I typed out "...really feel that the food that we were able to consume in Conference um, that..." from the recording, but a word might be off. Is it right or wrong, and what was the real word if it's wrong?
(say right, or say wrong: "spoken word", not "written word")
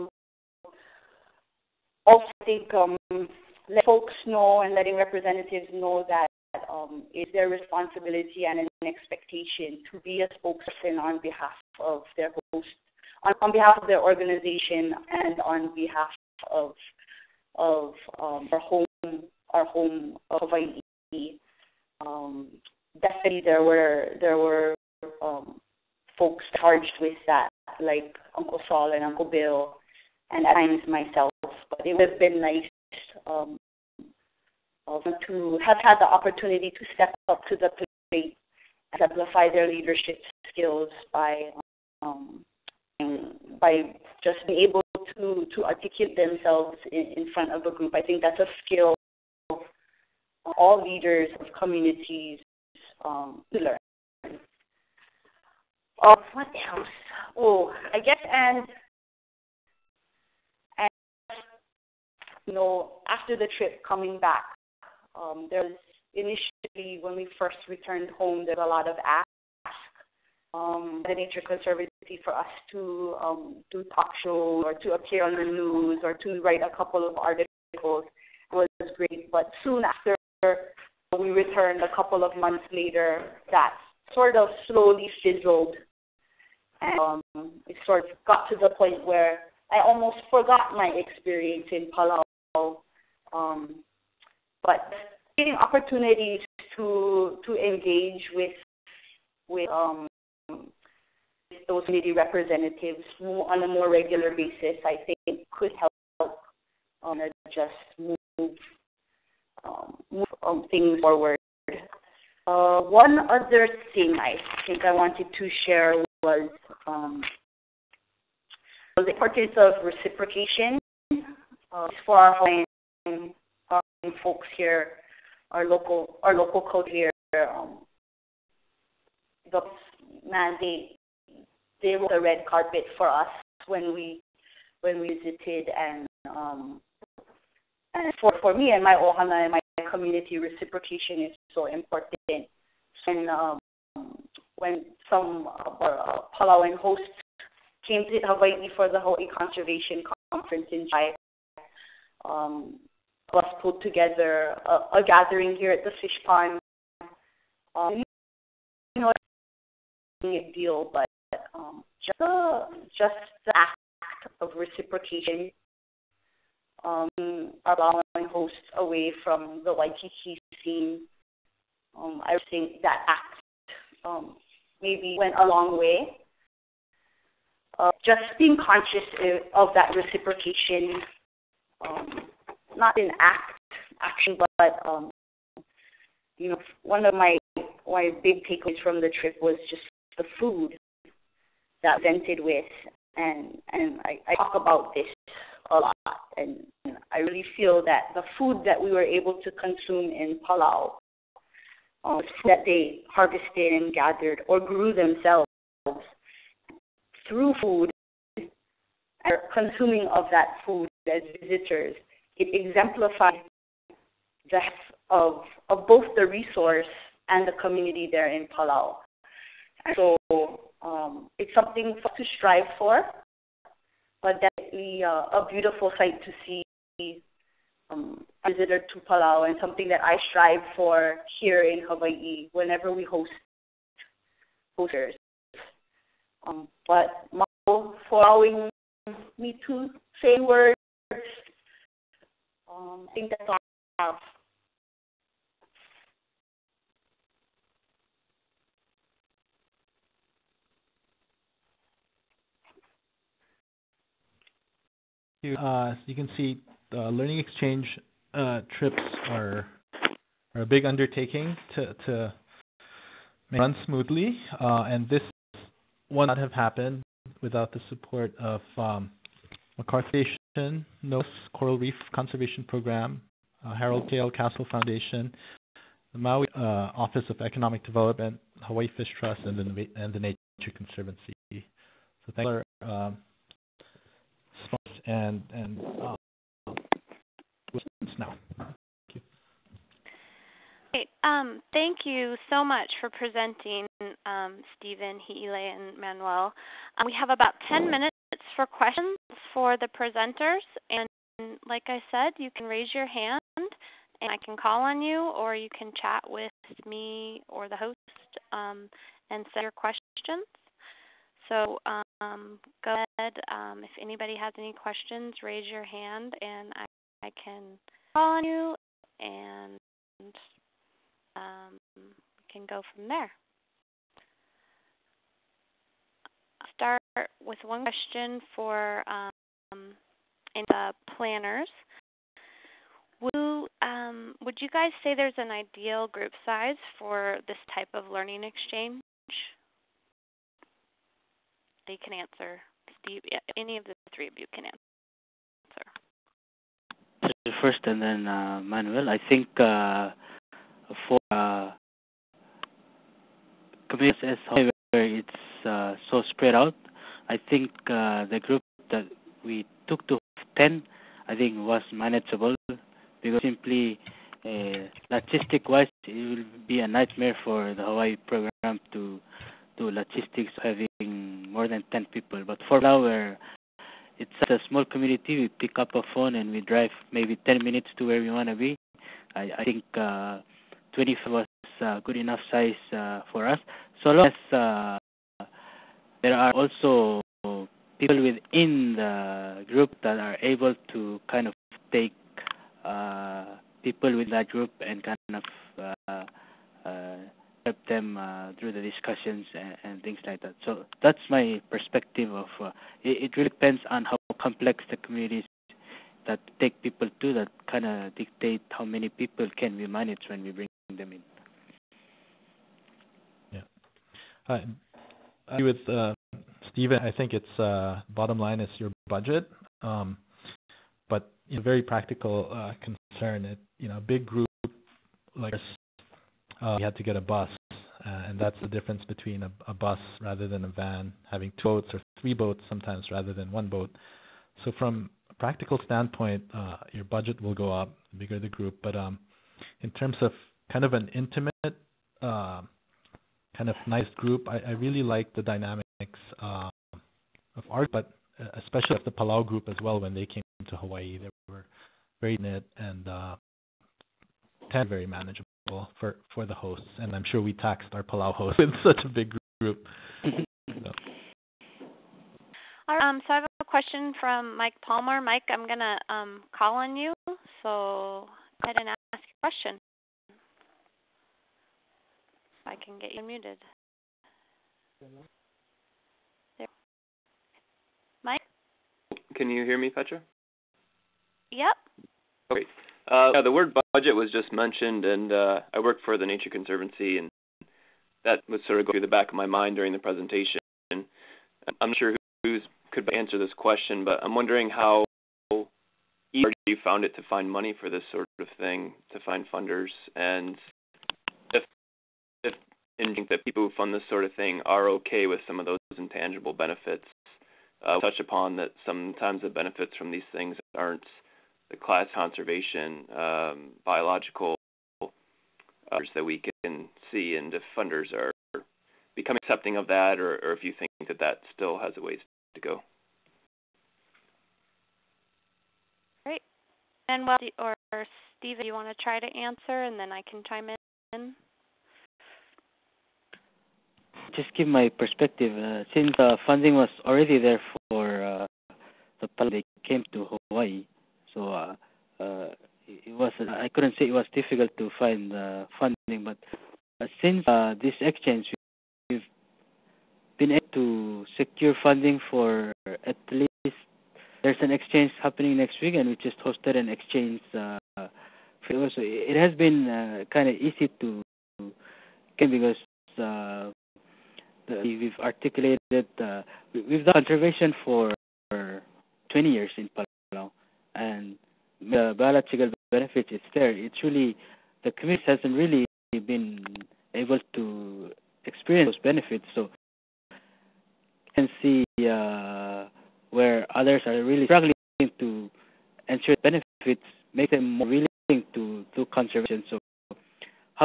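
wrong: "Palau", not "Conference".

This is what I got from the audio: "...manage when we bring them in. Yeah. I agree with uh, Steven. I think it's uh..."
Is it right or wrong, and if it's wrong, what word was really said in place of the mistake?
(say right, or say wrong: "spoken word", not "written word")
right.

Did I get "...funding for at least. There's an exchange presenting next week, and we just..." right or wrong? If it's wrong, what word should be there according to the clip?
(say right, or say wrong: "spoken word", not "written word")
wrong: "happening", not "presenting".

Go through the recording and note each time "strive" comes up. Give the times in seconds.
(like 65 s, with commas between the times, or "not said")
222 s, 230 s.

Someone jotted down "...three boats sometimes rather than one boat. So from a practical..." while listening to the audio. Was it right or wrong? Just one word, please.
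right.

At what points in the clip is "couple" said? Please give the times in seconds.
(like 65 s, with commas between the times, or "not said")
76 s, 81 s.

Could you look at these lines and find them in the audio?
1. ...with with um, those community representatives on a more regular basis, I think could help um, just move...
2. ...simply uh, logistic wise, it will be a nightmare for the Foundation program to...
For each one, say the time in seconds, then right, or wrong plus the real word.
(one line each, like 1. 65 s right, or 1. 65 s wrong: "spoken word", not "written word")
1. 98 s right
2. 363 s wrong: "Hawaii", not "Foundation".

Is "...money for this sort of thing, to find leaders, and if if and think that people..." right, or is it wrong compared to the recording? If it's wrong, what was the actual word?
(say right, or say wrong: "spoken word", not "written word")
wrong: "funders", not "leaders".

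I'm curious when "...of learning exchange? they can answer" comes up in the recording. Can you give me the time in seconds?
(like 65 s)
337 s.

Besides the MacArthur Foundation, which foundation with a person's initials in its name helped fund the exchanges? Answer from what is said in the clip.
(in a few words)
Harold K.L. Castle Foundation.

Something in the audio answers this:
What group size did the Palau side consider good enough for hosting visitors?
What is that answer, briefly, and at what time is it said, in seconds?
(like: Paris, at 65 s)
25, at 380 s.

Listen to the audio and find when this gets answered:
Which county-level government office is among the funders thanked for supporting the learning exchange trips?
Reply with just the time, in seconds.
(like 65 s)
276 s.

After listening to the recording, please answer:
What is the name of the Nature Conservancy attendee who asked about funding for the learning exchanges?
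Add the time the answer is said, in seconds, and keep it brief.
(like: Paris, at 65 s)
Mike Palmer, at 464 s.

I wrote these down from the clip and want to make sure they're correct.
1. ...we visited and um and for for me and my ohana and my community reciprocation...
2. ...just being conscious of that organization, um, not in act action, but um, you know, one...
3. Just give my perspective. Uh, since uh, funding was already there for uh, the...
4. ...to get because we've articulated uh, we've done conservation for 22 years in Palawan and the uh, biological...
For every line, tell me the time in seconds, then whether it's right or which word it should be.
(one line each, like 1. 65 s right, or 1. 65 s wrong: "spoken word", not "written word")
1. 134 s right
2. 178 s wrong: "reciprocation", not "organization"
3. 534 s right
4. 561 s wrong: "20", not "22".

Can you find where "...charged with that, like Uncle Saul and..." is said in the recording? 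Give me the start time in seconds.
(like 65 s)
26 s.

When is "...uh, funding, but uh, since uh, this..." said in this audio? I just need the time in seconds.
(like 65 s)
545 s.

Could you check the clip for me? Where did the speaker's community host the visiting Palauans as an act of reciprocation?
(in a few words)
the fish pond.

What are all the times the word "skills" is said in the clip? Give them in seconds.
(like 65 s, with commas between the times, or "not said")
40 s, 48 s.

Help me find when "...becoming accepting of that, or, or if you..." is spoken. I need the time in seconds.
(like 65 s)
519 s.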